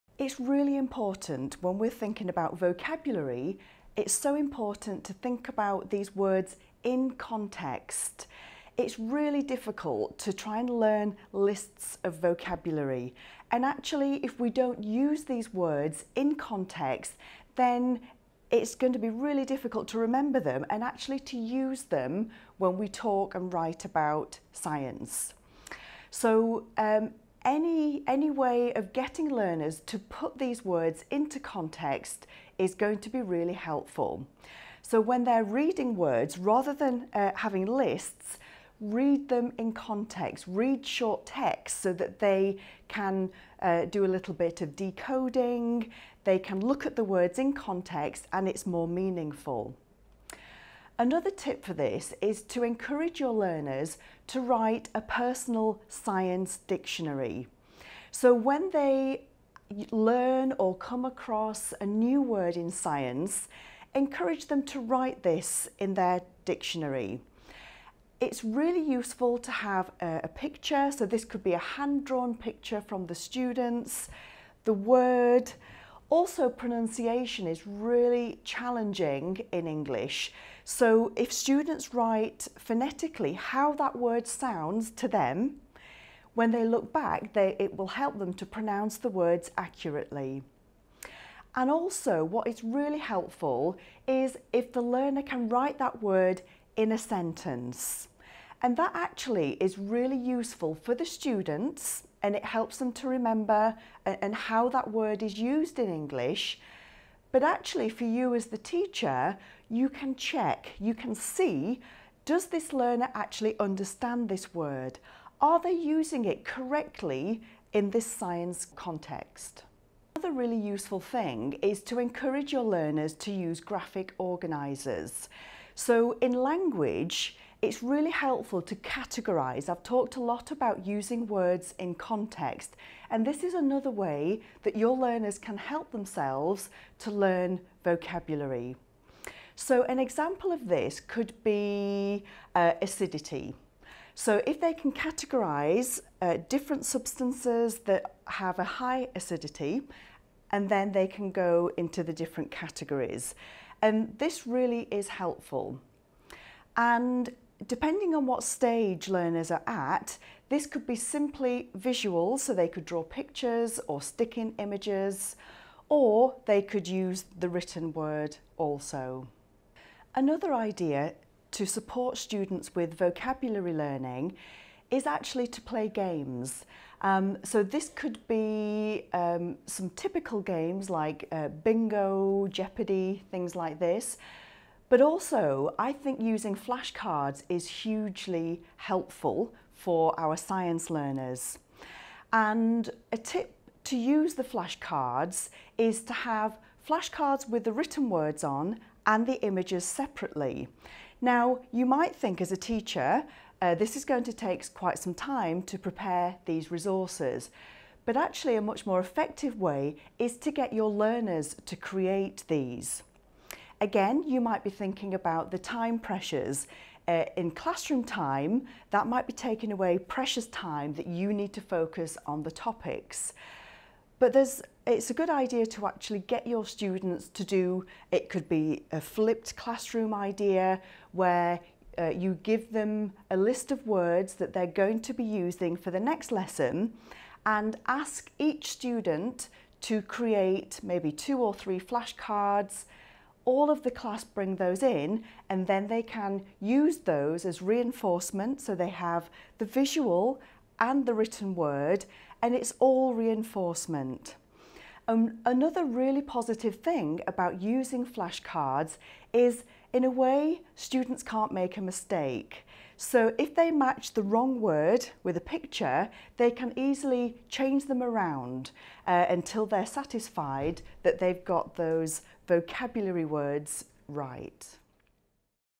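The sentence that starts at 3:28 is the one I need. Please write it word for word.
But actually a much more effective way is to get your learners to create these.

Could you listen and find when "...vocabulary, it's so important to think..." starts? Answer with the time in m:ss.
0:02.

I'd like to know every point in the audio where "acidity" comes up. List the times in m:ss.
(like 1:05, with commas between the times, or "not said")
2:22, 2:29.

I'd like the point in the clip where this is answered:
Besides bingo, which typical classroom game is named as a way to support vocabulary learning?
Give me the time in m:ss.
3:02.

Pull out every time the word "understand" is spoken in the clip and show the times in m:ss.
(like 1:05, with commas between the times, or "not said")
1:53.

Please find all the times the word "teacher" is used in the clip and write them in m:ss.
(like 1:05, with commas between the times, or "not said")
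1:48, 3:22.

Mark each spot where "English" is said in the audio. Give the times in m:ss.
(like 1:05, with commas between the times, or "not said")
1:19, 1:45.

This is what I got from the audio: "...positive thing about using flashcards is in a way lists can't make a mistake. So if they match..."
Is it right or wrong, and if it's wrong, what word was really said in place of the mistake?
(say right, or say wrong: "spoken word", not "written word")
wrong: "students", not "lists".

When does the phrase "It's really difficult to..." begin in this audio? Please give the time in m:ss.
0:08.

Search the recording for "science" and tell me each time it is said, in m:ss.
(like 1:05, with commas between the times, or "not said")
0:24, 0:55, 1:02, 1:58, 3:10.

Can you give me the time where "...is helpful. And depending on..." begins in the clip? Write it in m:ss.
2:34.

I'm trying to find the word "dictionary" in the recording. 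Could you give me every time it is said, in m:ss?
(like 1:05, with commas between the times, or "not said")
0:56, 1:06.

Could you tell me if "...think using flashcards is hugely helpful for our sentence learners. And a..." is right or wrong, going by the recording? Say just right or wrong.
wrong.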